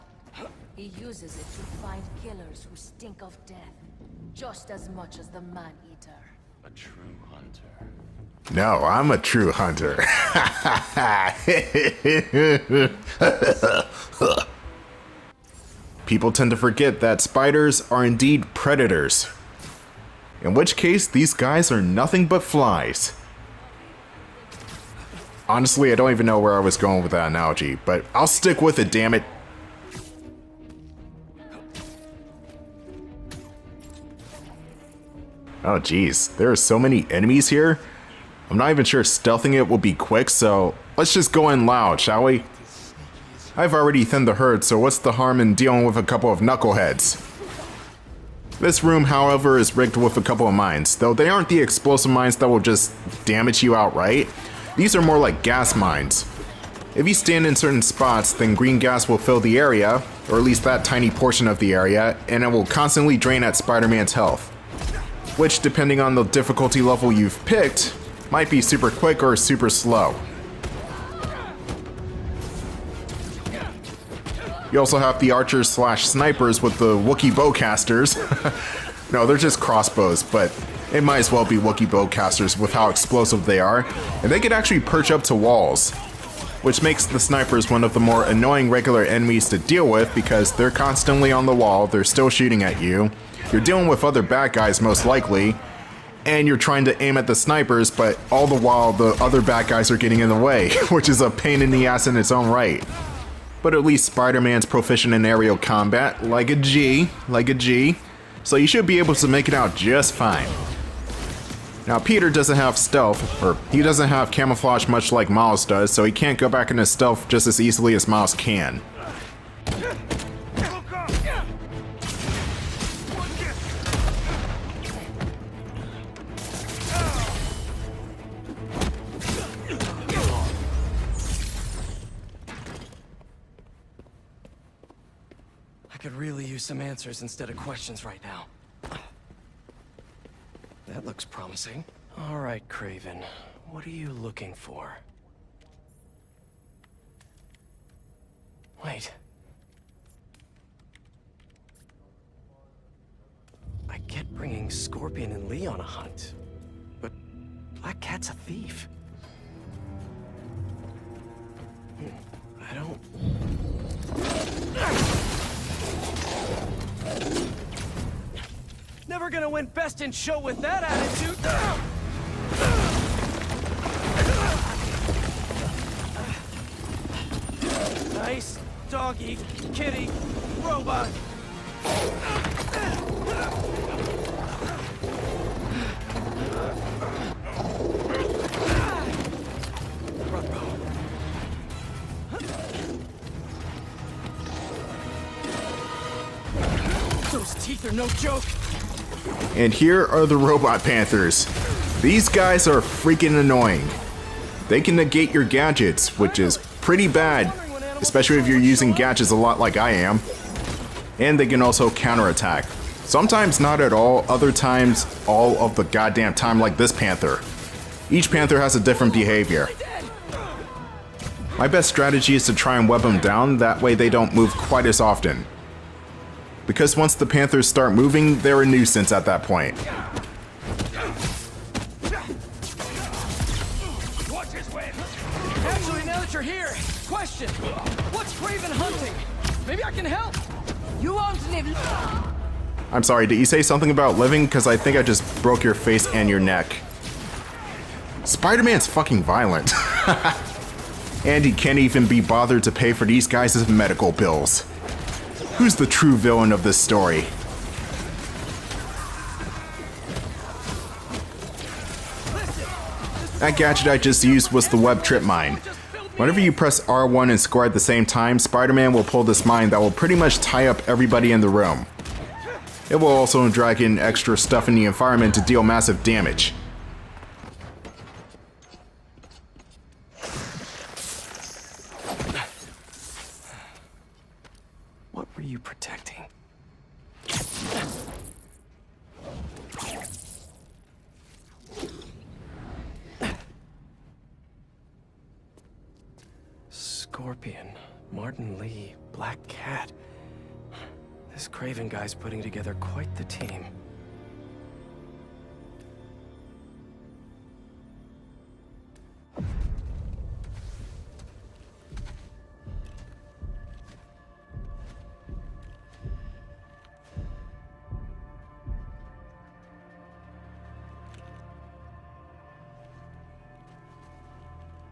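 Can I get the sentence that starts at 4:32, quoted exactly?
It will also drag in extra stuff in the environment to deal massive damage.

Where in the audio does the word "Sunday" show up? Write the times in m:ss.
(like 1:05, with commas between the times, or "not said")
not said.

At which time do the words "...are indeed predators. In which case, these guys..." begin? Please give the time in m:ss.
0:17.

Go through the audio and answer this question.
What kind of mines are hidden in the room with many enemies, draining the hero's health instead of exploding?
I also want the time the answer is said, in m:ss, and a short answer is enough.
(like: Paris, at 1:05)
gas mines, at 0:55.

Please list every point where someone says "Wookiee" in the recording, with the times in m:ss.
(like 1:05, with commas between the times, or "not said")
1:16, 1:21.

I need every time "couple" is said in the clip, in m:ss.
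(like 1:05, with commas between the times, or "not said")
0:46, 0:50.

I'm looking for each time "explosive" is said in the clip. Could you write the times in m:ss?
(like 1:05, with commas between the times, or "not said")
0:51, 1:22.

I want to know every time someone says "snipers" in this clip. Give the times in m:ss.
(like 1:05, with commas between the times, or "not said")
1:16, 1:27, 1:37.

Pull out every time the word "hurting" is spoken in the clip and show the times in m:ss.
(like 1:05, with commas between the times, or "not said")
not said.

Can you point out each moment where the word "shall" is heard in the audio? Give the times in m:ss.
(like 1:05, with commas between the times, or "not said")
0:42.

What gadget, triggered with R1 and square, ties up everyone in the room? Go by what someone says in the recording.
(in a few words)
web trip mine.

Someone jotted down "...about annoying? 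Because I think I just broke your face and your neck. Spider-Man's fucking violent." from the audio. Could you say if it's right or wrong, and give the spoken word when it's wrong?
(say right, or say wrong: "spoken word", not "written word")
wrong: "living", not "annoying".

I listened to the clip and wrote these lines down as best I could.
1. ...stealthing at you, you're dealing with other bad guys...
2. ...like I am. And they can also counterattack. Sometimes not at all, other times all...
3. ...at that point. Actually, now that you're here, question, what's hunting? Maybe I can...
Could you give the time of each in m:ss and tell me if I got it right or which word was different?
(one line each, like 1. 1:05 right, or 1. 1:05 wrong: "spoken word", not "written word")
1. 1:32 wrong: "shooting", not "stealthing"
2. 3:29 right
3. 3:49 right.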